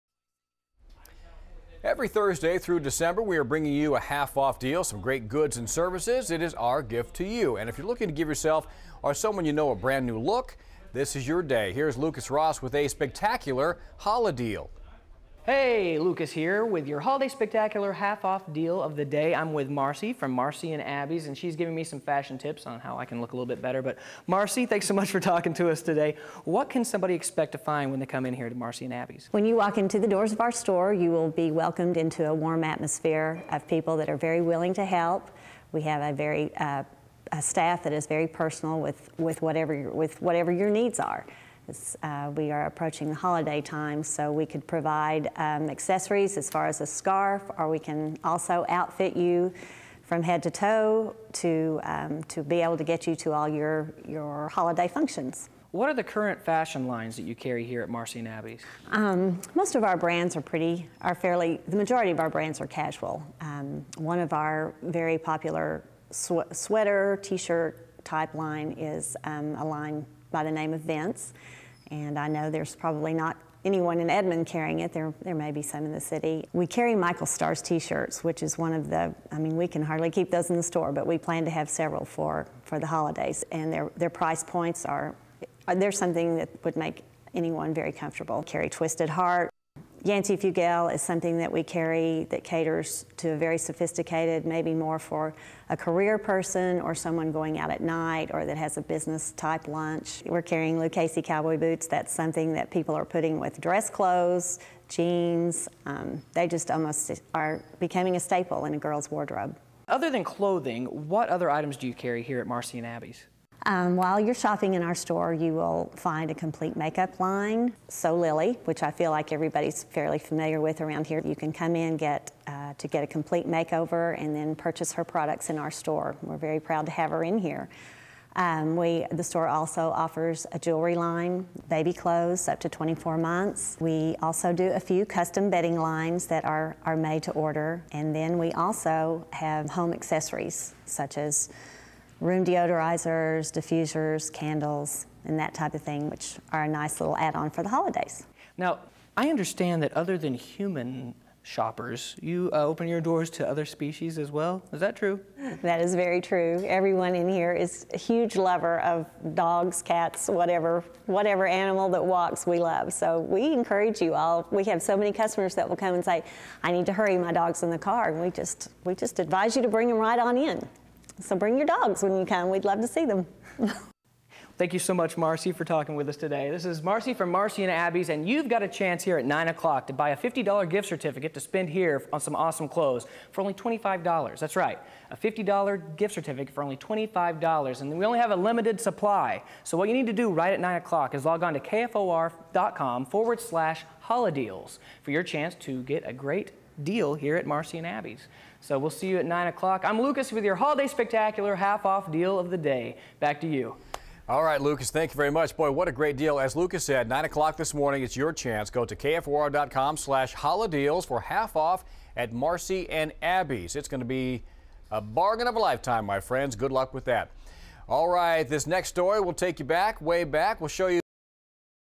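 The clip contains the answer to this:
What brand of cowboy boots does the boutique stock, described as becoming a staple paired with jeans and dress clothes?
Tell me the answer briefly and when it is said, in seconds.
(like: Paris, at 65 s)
Lucchese, at 100 s.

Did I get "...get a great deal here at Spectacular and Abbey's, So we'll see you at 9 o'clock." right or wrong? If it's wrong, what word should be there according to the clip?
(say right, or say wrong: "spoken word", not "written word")
wrong: "Marcy", not "Spectacular".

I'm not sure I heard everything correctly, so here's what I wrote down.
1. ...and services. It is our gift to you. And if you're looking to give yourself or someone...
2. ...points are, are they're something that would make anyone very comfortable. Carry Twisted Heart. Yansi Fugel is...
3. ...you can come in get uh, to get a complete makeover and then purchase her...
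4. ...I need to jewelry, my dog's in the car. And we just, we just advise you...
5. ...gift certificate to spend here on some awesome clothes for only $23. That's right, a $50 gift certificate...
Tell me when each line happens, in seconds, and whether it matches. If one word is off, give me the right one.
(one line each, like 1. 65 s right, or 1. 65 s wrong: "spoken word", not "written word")
1. 5 s right
2. 84 s right
3. 121 s right
4. 166 s wrong: "hurry", not "jewelry"
5. 180 s wrong: "25", not "23".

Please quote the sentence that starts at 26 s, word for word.
What can somebody expect to find when they come in here to Marcy and Abbey's?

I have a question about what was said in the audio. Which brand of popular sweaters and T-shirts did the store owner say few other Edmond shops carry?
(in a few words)
Vince.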